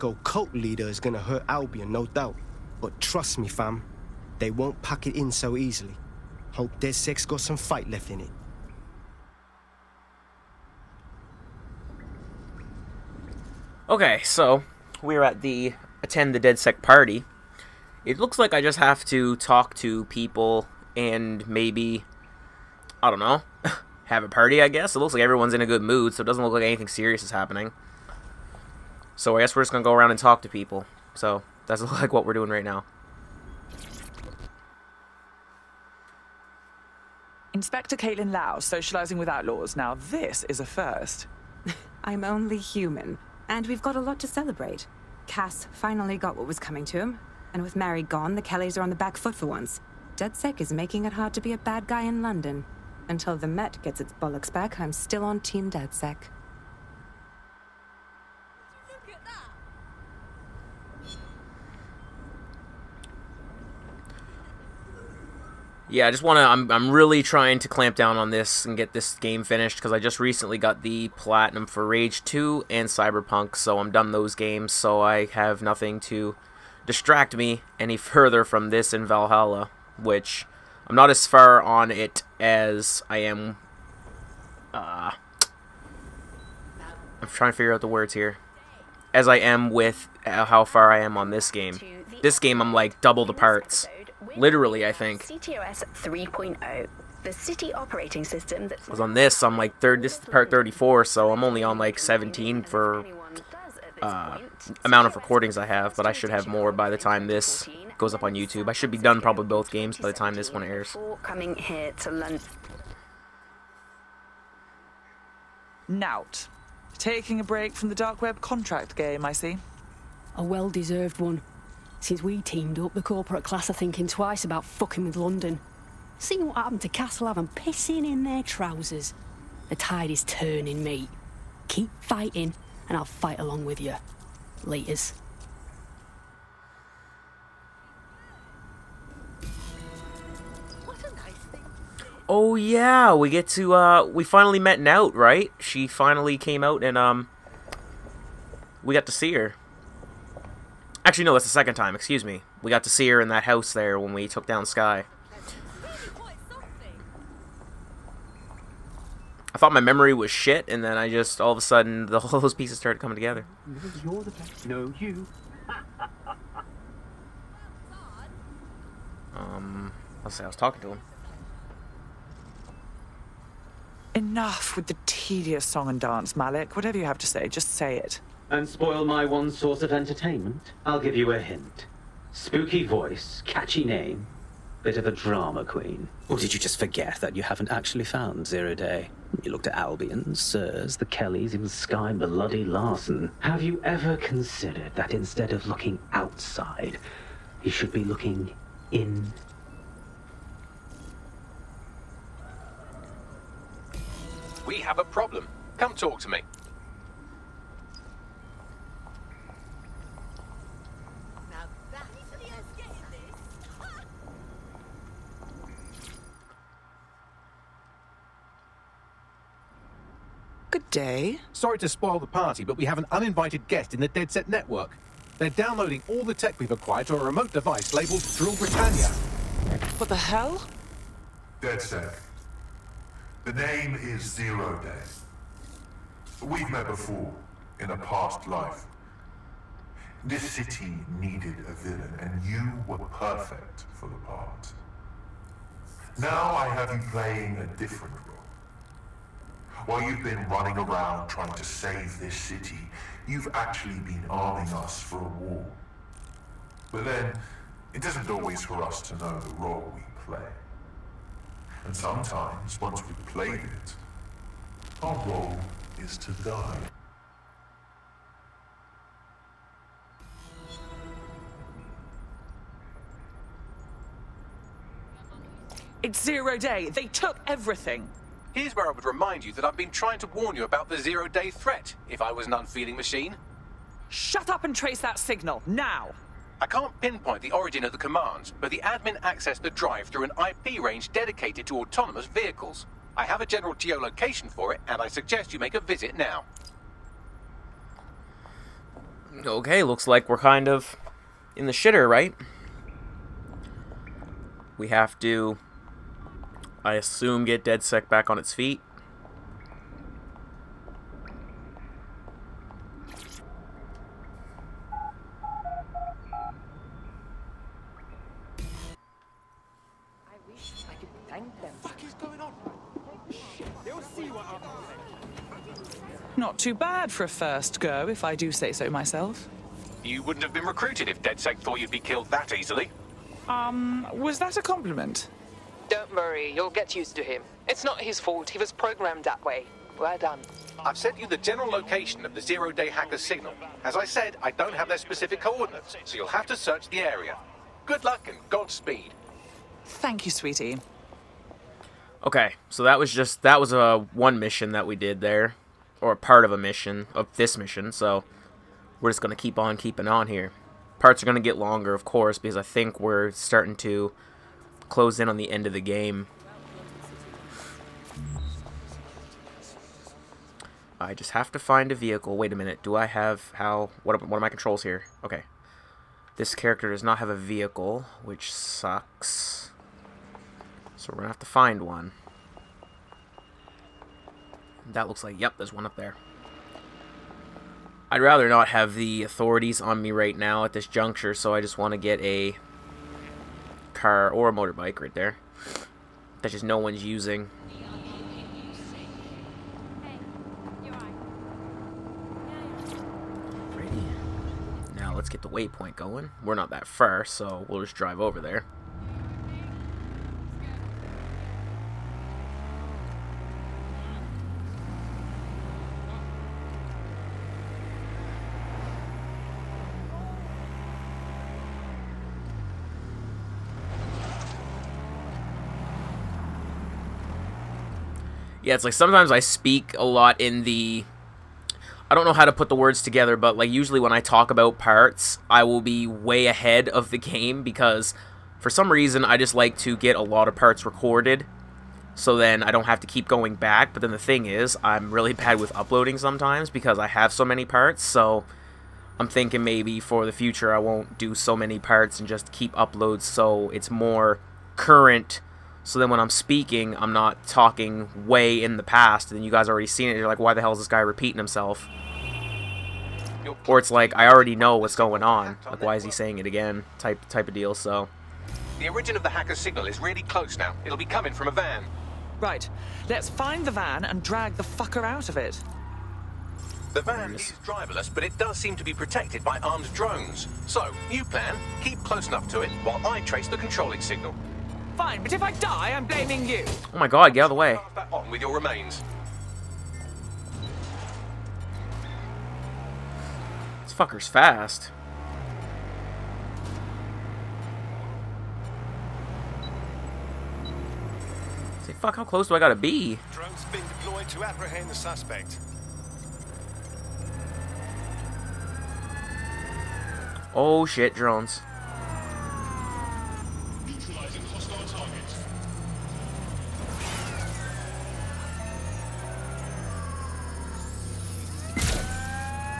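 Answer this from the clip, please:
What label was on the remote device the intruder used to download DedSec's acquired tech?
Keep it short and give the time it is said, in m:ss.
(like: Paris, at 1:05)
Drill Britannia, at 3:48.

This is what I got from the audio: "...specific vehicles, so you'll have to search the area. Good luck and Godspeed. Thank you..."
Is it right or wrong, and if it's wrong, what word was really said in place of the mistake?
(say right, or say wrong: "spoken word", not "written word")
wrong: "coordinates", not "vehicles".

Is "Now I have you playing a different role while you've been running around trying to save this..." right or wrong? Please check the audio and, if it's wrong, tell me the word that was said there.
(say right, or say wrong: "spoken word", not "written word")
right.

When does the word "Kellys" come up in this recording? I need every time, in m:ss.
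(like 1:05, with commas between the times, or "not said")
0:48, 3:11.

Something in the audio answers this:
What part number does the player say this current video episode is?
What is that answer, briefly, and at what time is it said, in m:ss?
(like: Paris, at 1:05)
34, at 1:40.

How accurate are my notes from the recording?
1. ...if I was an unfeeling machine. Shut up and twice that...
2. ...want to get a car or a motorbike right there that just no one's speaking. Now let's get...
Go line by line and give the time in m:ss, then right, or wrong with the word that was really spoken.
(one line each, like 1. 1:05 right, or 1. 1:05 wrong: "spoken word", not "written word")
1. 4:42 wrong: "trace", not "twice"
2. 6:31 wrong: "using", not "speaking".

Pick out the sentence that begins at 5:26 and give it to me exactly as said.
Not too bad for a first go, if I do say so myself.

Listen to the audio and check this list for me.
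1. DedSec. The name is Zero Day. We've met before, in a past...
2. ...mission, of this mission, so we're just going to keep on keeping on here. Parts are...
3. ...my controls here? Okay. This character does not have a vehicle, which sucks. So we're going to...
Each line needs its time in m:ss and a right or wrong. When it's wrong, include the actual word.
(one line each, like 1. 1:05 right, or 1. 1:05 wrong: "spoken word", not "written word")
1. 3:51 right
2. 5:56 right
3. 6:14 right.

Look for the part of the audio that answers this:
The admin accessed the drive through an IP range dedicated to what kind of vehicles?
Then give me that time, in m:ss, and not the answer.
4:51.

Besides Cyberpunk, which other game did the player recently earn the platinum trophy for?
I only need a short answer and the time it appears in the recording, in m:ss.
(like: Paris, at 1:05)
Rage 2, at 1:11.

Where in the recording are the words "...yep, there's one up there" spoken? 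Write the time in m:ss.
6:25.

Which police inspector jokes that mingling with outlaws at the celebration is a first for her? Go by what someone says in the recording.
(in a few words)
Caitlin Lau.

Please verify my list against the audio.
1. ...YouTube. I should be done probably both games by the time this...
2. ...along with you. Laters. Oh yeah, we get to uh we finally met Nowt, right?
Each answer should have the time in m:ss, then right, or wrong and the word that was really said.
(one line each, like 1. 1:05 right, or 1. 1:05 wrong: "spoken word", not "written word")
1. 1:48 right
2. 2:13 right.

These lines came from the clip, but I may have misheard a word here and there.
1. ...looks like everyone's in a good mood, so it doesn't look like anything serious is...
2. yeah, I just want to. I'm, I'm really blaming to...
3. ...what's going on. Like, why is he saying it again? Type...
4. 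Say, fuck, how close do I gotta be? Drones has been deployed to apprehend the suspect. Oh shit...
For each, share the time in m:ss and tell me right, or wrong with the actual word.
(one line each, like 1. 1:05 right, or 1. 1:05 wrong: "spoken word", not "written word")
1. 0:24 right
2. 1:05 wrong: "trying", not "blaming"
3. 7:44 right
4. 8:21 right.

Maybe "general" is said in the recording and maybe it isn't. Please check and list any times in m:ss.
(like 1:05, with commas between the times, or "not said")
4:53, 5:41.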